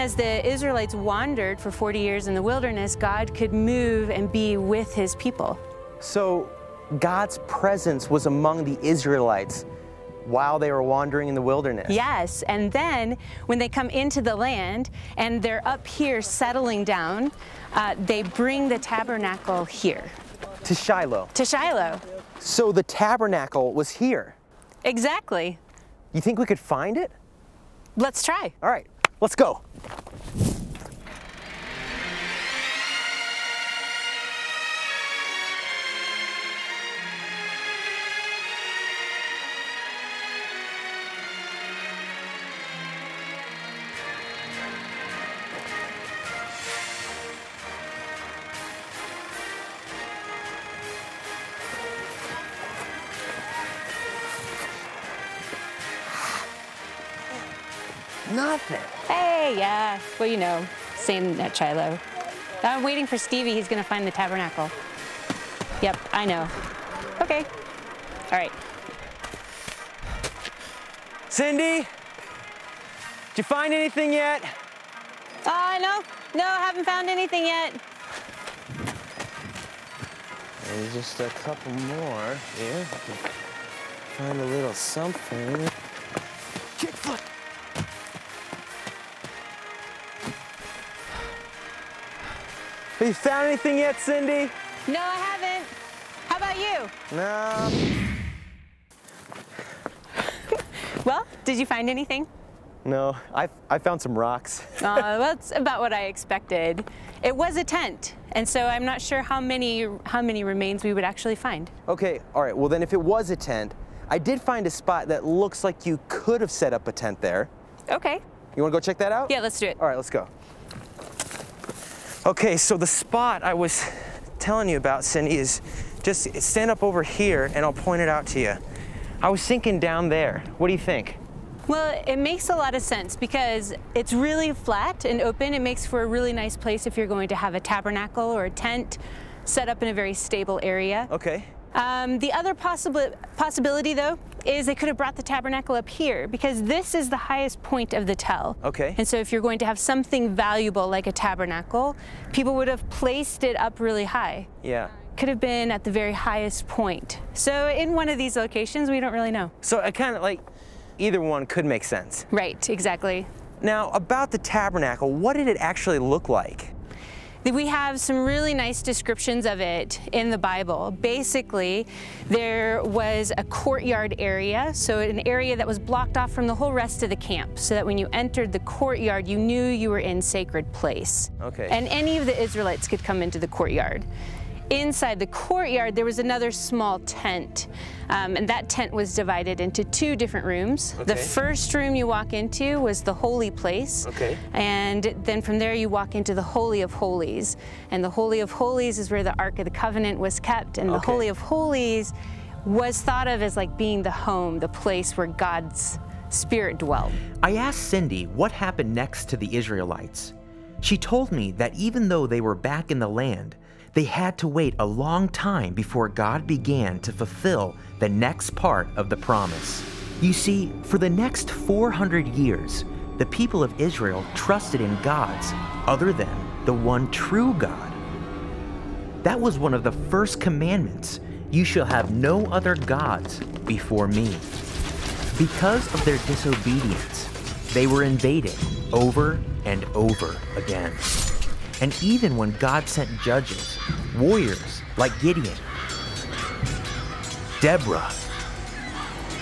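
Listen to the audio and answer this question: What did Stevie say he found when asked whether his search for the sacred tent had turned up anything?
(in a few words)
Some rocks.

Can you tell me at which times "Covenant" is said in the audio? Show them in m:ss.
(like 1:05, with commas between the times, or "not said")
3:19.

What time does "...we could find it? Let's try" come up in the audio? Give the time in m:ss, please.
0:26.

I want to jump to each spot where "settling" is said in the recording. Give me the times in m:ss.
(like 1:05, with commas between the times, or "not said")
0:16.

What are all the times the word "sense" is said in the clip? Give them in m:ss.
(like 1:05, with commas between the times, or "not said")
2:12, 2:41.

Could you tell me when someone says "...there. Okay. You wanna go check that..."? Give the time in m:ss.
1:57.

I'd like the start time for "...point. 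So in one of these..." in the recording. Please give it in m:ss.
2:36.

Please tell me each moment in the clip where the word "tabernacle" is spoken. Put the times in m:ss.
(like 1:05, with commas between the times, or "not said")
0:18, 0:22, 1:04, 2:17, 2:25, 2:31, 2:44.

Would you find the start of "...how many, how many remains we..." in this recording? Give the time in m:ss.
1:49.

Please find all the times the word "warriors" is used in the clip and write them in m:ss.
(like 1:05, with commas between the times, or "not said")
4:04.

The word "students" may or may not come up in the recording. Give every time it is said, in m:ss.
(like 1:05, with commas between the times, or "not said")
not said.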